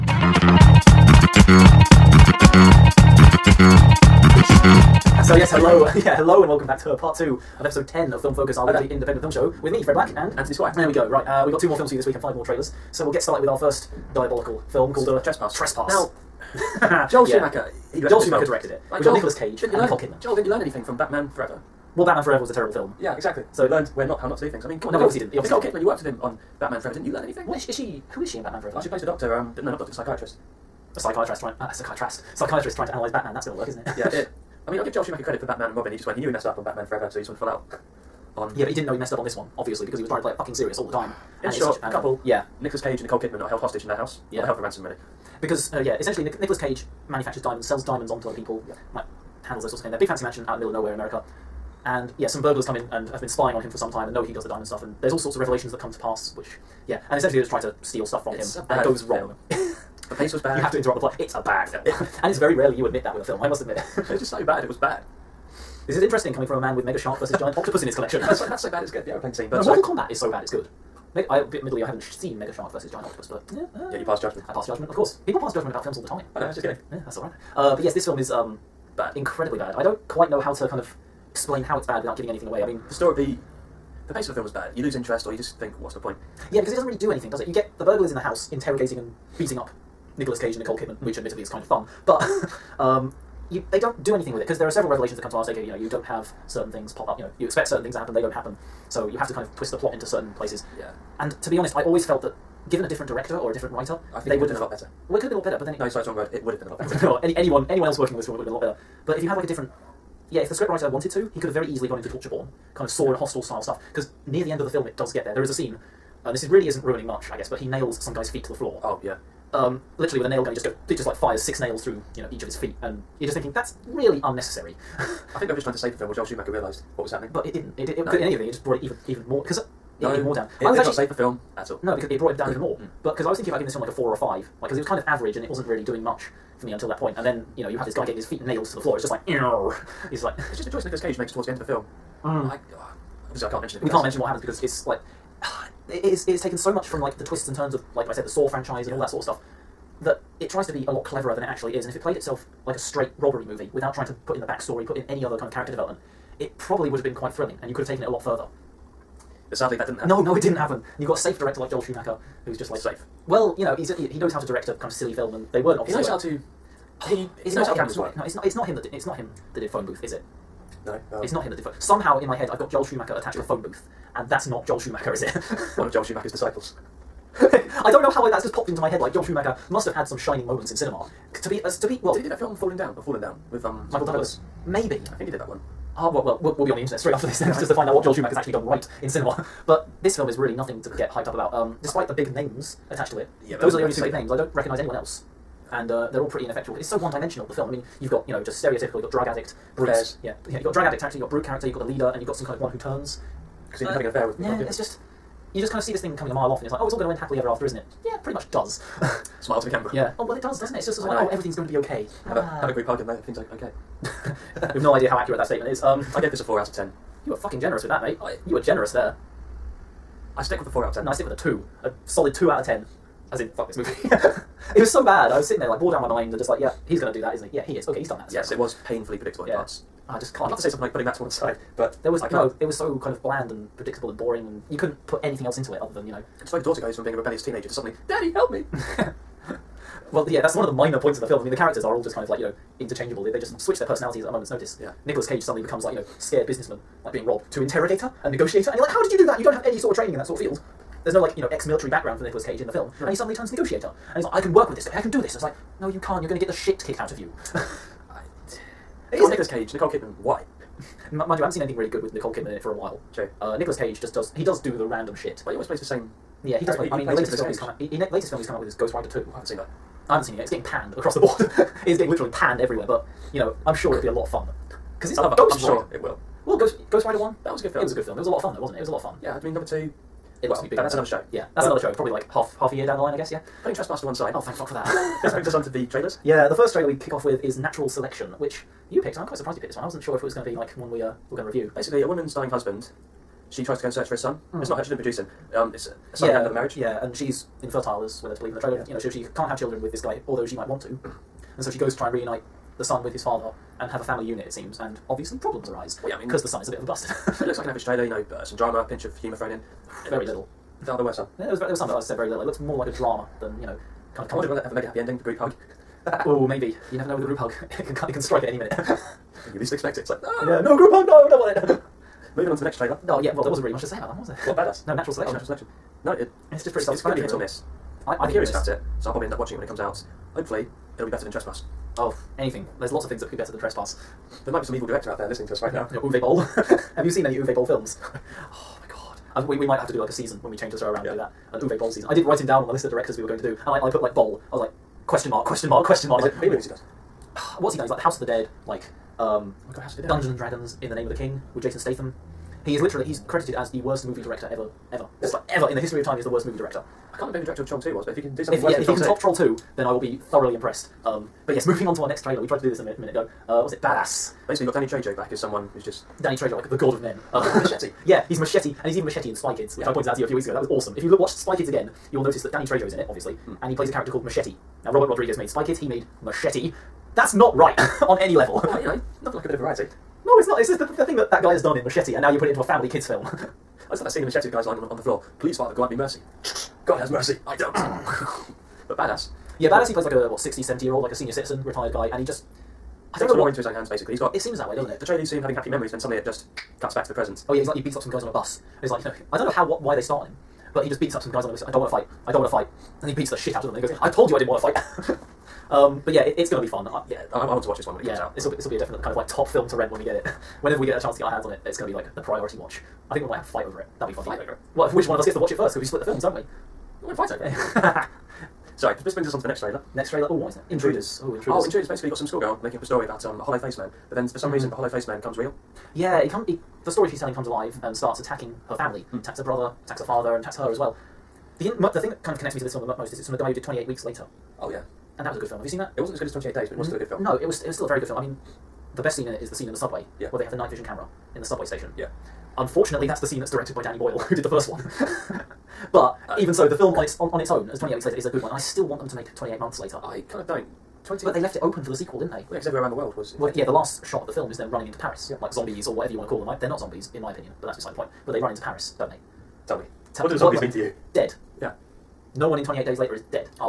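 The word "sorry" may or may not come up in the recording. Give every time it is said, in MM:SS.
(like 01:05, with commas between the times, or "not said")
01:45, 06:58.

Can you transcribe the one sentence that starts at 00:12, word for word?
So we'll get started with our first diabolical film called uh, Trespass.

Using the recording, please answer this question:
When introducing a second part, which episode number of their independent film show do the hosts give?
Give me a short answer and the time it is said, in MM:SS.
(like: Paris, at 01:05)
10, at 00:07.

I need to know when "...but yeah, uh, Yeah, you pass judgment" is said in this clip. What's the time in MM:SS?
01:13.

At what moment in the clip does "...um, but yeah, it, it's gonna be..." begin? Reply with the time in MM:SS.
06:45.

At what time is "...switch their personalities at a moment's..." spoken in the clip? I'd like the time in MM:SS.
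04:03.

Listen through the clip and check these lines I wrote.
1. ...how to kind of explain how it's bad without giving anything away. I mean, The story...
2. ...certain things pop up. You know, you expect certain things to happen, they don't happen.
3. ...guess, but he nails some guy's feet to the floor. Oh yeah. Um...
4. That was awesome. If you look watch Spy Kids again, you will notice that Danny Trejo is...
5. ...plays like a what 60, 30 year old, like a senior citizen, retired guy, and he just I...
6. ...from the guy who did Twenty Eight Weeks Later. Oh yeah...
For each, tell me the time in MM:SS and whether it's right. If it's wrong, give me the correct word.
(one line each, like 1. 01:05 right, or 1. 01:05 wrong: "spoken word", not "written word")
1. 01:20 right
2. 01:36 right
3. 01:57 right
4. 06:10 right
5. 06:29 wrong: "70", not "30"
6. 07:13 right.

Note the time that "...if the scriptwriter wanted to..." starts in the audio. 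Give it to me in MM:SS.
01:50.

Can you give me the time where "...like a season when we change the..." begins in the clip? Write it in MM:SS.
05:40.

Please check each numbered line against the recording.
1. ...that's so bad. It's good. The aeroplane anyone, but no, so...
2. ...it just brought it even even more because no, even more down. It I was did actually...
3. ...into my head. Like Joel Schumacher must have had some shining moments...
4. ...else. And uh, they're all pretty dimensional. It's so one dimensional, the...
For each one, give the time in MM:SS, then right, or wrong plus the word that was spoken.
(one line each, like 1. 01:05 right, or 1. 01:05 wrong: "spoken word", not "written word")
1. 01:08 wrong: "scene", not "anyone"
2. 02:08 right
3. 02:58 right
4. 03:14 wrong: "ineffectual", not "dimensional".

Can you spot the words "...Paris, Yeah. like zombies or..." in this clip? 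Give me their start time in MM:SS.
07:34.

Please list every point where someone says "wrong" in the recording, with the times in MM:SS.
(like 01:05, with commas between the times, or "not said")
00:59, 01:46.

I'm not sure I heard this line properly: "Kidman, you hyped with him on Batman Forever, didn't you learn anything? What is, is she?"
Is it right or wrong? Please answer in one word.
wrong.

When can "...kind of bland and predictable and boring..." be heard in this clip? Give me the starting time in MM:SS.
03:53.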